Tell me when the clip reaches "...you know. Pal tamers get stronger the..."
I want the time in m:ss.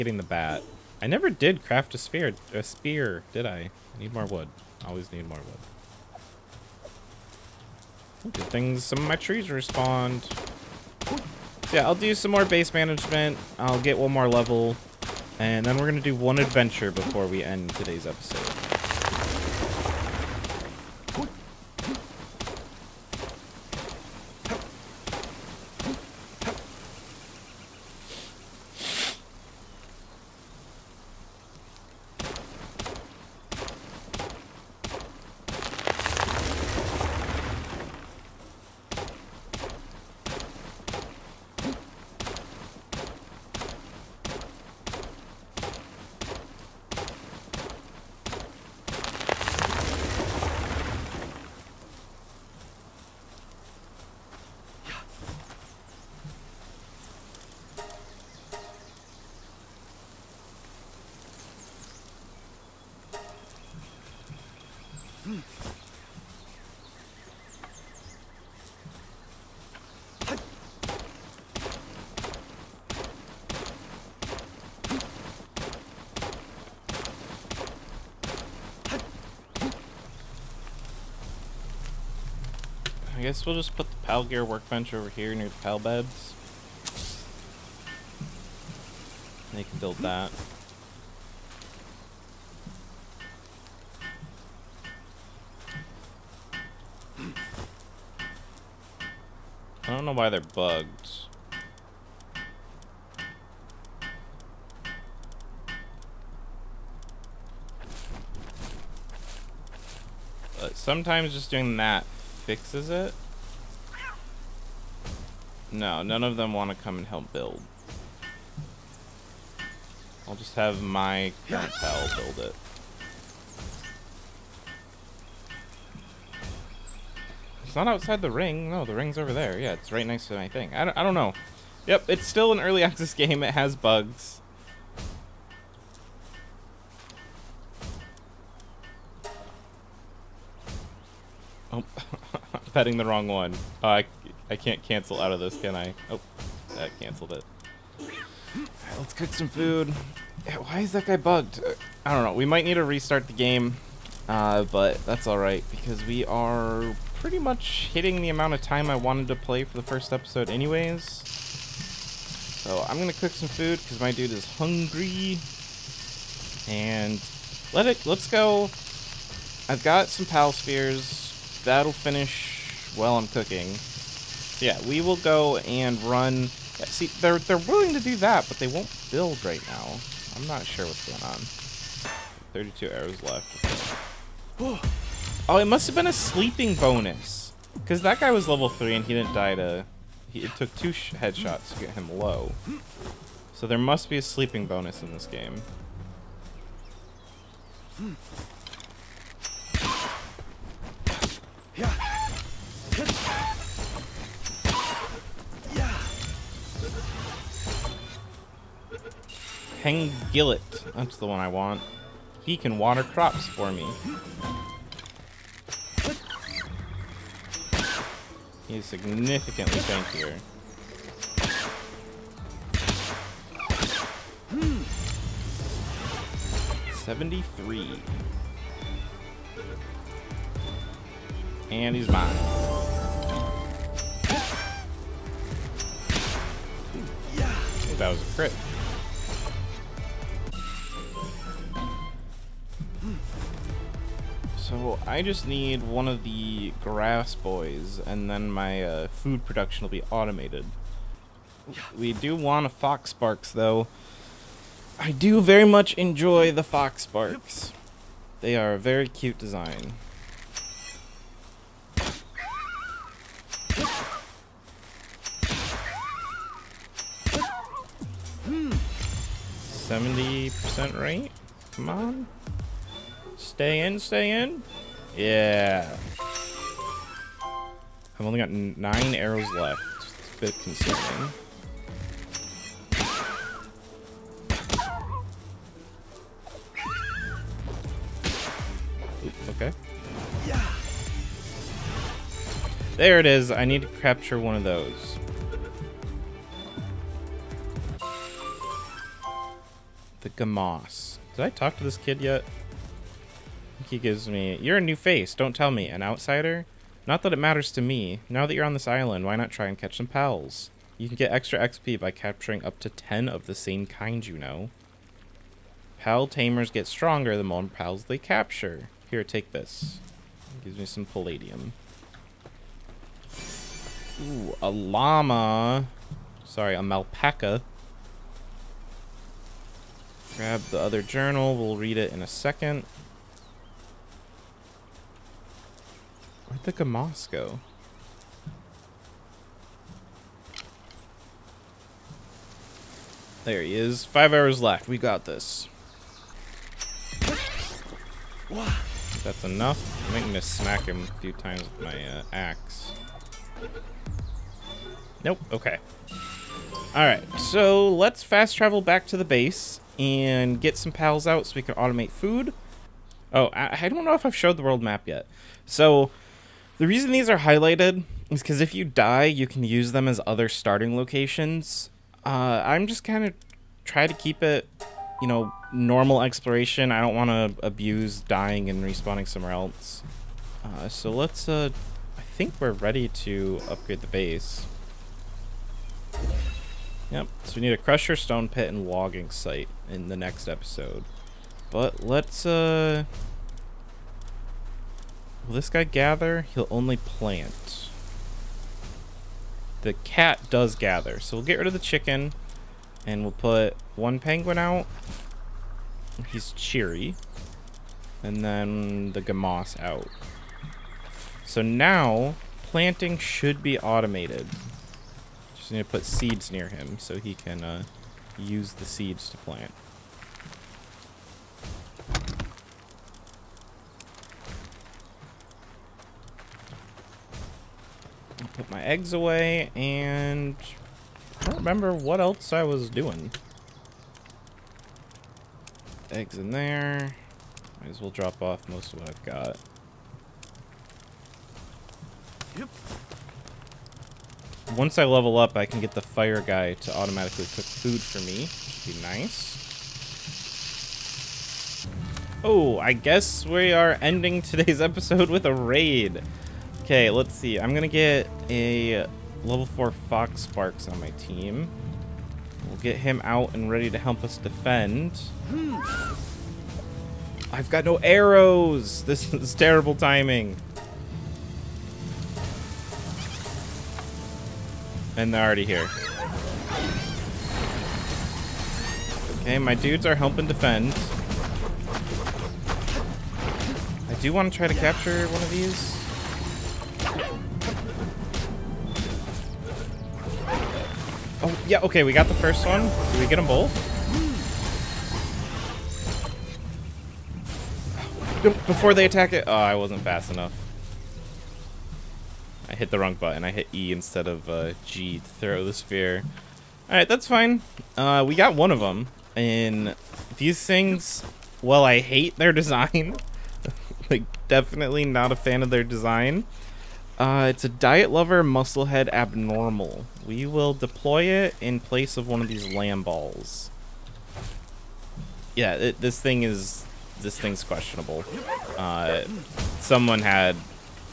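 5:14.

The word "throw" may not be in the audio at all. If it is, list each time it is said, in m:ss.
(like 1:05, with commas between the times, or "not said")
8:25.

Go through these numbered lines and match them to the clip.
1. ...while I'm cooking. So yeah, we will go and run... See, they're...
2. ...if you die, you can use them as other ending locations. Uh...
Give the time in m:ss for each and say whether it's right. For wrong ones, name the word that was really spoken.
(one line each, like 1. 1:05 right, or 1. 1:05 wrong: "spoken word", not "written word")
1. 2:52 right
2. 6:08 wrong: "starting", not "ending".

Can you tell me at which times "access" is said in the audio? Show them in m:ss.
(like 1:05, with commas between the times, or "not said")
2:12.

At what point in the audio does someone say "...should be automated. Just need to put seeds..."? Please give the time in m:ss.
6:53.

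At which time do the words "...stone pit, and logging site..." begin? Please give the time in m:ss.
6:28.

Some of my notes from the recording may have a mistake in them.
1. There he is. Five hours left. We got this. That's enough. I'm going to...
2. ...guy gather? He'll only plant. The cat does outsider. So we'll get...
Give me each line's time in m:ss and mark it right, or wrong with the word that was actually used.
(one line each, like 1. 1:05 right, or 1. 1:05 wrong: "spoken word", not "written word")
1. 5:43 right
2. 6:35 wrong: "gather", not "outsider".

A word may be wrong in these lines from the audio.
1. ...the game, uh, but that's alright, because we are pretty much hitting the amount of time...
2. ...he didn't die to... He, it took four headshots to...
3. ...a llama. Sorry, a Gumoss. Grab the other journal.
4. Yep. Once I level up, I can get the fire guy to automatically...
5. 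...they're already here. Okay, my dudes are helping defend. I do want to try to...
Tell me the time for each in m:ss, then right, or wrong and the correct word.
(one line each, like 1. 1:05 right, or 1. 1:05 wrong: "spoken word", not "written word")
1. 2:33 right
2. 3:09 wrong: "two", not "four"
3. 5:24 wrong: "Melpaca", not "Gumoss"
4. 7:22 right
5. 7:55 right.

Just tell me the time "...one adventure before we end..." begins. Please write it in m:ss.
0:16.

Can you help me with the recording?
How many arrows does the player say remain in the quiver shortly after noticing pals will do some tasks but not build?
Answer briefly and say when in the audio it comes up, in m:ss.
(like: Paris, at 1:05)
32, at 3:02.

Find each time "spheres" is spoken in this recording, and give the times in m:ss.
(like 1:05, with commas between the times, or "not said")
2:50, 8:25.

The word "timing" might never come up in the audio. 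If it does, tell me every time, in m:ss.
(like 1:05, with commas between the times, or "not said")
7:49.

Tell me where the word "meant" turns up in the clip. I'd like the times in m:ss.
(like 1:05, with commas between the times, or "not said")
not said.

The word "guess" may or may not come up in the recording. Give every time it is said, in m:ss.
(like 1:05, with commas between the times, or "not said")
1:23, 7:32.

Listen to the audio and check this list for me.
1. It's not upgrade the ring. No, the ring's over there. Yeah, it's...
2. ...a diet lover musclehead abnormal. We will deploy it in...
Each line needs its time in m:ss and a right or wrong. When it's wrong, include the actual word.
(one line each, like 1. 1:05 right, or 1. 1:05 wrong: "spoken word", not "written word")
1. 2:07 wrong: "outside", not "upgrade"
2. 8:37 right.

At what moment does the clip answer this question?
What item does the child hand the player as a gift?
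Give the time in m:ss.
5:21.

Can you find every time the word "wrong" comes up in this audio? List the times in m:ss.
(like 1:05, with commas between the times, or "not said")
2:23, 8:22.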